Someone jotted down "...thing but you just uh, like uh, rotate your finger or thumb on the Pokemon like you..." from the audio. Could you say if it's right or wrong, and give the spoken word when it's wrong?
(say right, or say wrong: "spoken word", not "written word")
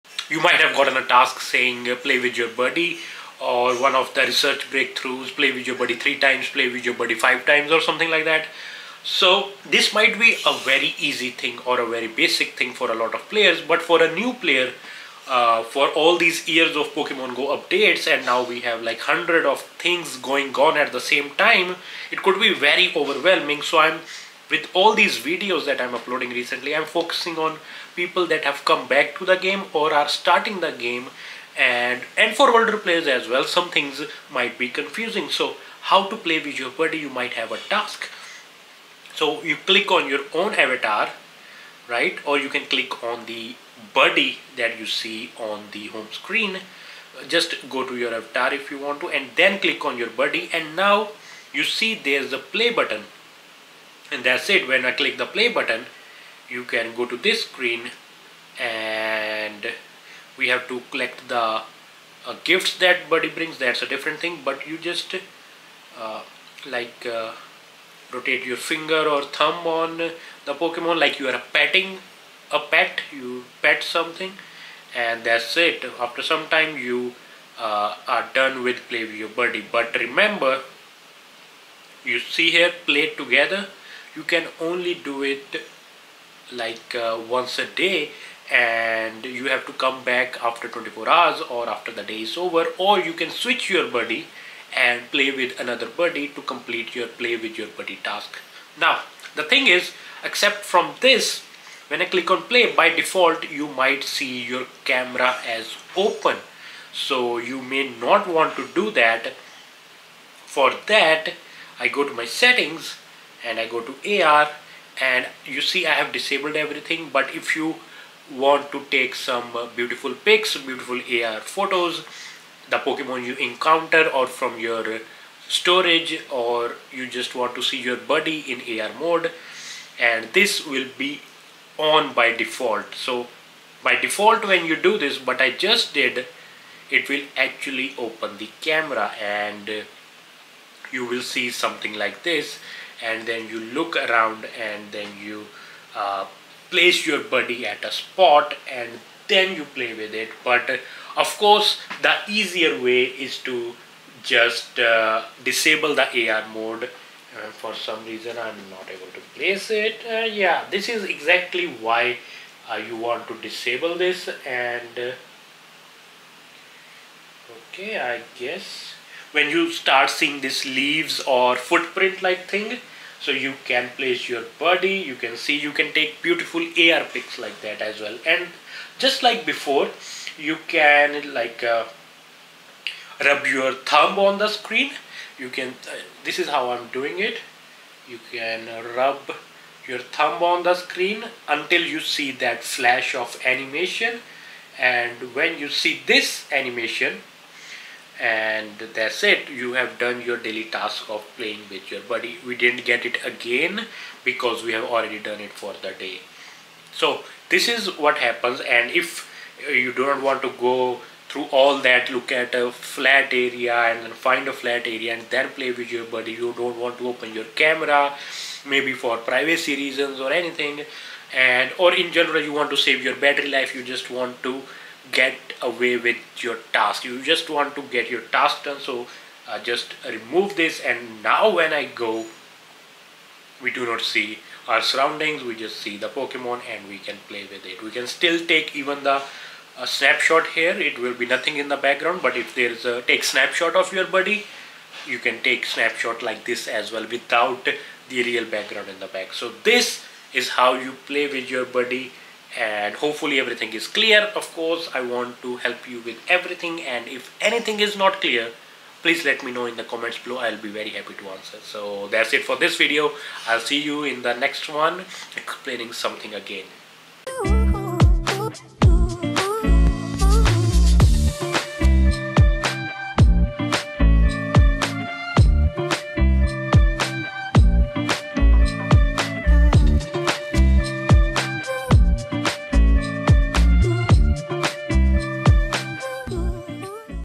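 right.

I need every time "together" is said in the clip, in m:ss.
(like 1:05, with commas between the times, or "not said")
1:23.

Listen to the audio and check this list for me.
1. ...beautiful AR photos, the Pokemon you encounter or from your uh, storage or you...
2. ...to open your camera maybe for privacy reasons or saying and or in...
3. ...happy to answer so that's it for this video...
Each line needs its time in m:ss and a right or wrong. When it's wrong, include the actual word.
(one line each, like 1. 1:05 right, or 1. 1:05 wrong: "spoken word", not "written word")
1. 2:00 right
2. 3:36 wrong: "anything", not "saying"
3. 4:20 right.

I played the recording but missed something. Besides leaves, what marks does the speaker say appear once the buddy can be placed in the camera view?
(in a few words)
footprint.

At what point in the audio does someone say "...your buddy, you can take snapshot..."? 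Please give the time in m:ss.
4:03.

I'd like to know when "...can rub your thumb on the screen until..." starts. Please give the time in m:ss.
3:08.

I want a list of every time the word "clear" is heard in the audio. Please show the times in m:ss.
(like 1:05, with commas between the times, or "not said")
4:13, 4:18.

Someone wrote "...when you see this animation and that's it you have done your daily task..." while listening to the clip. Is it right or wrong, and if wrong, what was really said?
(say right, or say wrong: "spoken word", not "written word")
right.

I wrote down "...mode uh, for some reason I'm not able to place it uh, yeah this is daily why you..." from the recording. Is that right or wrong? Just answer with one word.
wrong.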